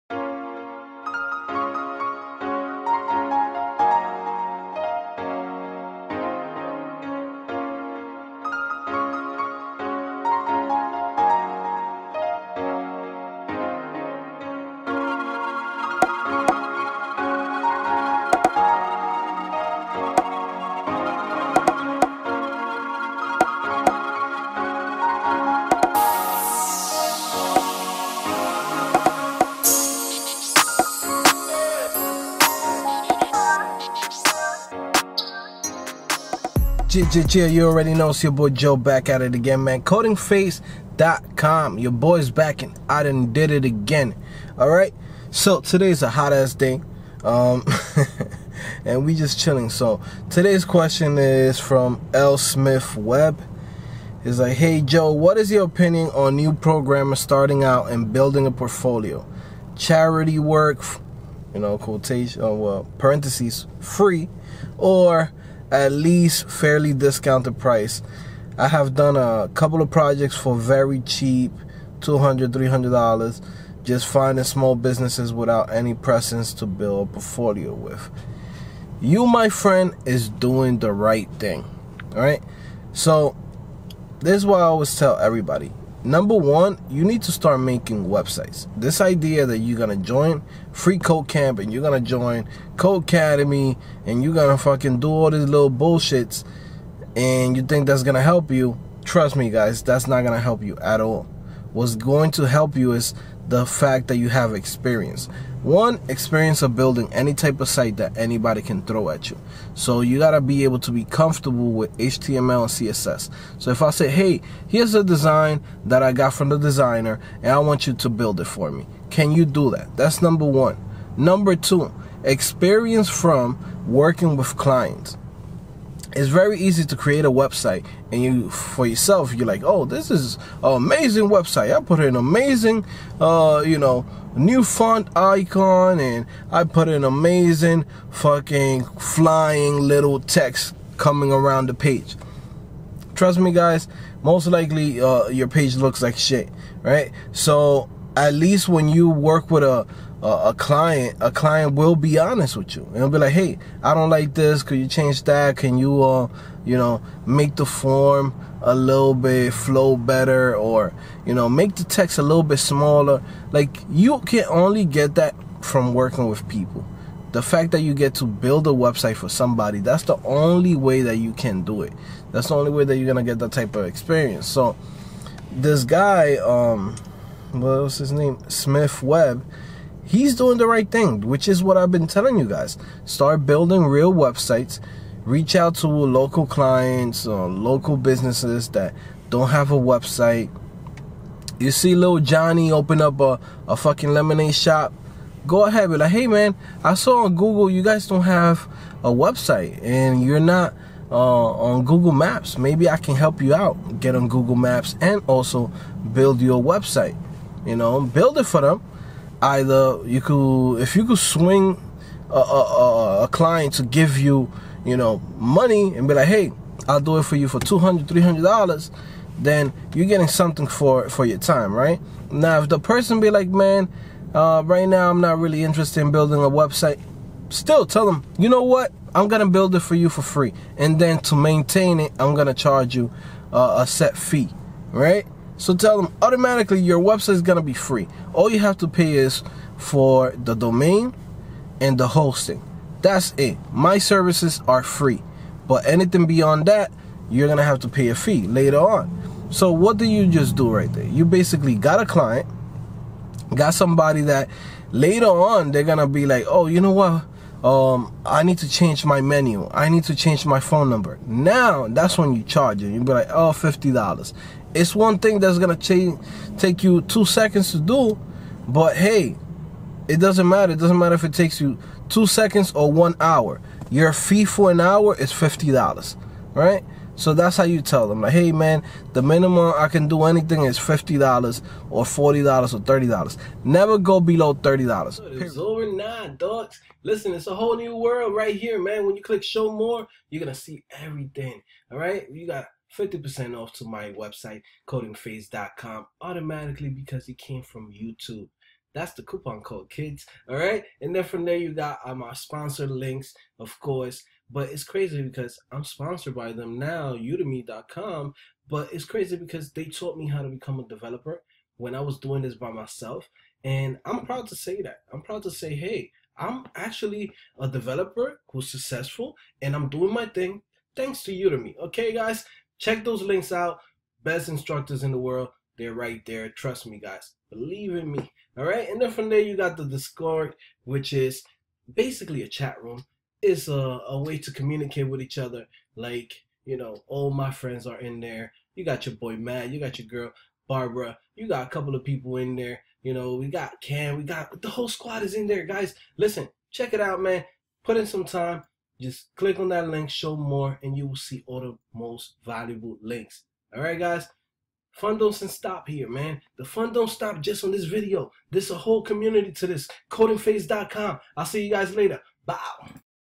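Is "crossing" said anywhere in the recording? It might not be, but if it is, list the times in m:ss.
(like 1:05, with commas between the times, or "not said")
not said.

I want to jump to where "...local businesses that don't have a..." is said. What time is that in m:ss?
3:07.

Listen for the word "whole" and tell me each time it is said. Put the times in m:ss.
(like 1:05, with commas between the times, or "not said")
4:47, 5:44, 5:58.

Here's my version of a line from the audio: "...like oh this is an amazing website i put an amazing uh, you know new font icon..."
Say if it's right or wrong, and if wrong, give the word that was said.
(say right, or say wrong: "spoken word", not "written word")
right.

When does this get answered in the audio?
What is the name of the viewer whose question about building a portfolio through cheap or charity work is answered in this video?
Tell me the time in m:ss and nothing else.
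0:52.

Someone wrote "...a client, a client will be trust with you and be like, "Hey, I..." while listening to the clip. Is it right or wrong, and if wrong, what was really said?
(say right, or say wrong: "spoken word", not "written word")
wrong: "honest", not "trust".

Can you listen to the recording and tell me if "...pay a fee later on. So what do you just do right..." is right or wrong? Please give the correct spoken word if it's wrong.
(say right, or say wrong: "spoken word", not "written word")
right.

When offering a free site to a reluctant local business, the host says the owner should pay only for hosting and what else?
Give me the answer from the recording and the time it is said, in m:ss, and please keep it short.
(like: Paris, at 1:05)
The domain, at 4:00.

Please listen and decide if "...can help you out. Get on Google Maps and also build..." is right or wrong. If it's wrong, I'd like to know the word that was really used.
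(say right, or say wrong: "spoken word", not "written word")
right.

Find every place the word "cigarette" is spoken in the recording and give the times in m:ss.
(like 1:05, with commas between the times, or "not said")
not said.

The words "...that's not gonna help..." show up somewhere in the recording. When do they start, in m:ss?
1:39.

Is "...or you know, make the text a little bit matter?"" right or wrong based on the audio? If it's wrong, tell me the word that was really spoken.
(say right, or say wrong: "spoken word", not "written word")
wrong: "smaller", not "matter".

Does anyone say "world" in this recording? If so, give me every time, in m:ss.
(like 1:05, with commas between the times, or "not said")
4:47, 5:25.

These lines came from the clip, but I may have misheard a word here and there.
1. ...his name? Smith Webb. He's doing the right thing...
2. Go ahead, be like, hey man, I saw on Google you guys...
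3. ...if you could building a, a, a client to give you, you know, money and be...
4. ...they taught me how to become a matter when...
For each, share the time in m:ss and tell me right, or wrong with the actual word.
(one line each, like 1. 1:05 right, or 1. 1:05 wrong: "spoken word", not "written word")
1. 2:57 right
2. 3:15 right
3. 3:30 wrong: "swing", not "building"
4. 5:09 wrong: "developer", not "matter".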